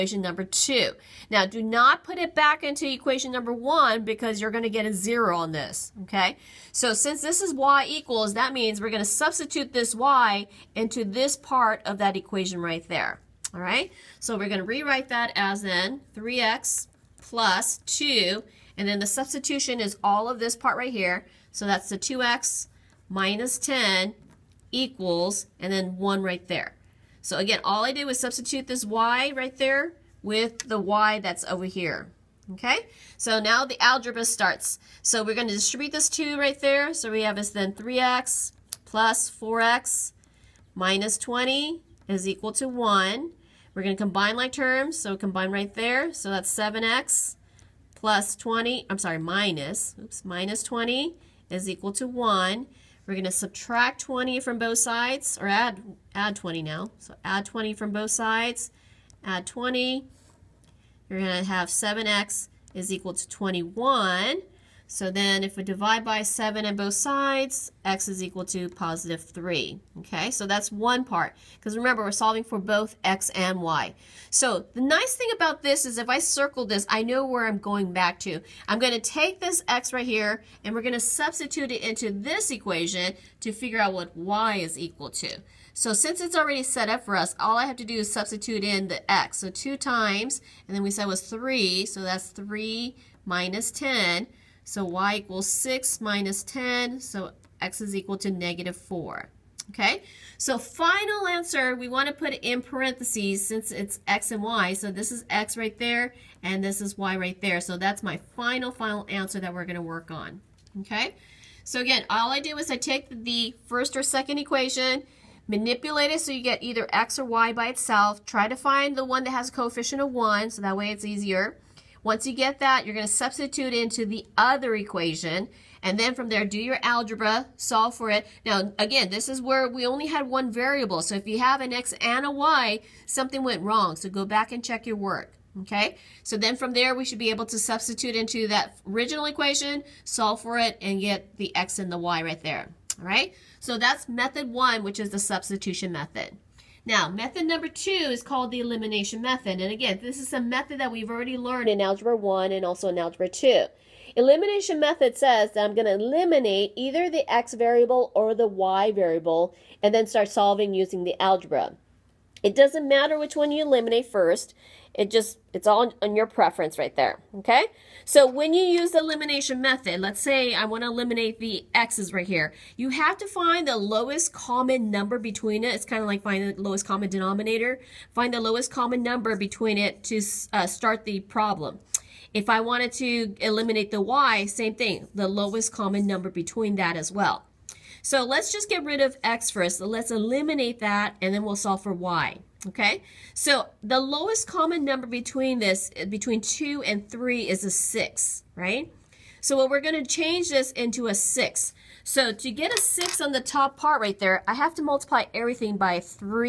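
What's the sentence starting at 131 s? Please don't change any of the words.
So if you have an X and a Y, something went wrong.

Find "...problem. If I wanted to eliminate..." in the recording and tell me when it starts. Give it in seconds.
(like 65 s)
181 s.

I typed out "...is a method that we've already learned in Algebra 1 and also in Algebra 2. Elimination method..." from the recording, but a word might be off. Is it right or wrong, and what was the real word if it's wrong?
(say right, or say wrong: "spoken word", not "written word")
right.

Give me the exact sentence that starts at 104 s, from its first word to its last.
So this is x right there, and this is y right there.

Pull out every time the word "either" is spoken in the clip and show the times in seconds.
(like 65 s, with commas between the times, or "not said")
116 s, 156 s.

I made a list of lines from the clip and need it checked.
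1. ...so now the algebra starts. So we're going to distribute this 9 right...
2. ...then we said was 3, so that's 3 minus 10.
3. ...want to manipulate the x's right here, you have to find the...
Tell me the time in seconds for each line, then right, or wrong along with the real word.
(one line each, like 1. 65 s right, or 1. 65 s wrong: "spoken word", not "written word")
1. 33 s wrong: "2", not "9"
2. 90 s right
3. 170 s wrong: "eliminate", not "manipulate".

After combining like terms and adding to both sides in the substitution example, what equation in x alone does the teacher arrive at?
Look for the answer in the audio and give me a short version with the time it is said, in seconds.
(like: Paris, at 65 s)
7x = 21, at 61 s.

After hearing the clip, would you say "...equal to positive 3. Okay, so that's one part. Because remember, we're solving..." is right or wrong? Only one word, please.
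right.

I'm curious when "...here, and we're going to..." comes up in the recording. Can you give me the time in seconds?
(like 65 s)
80 s.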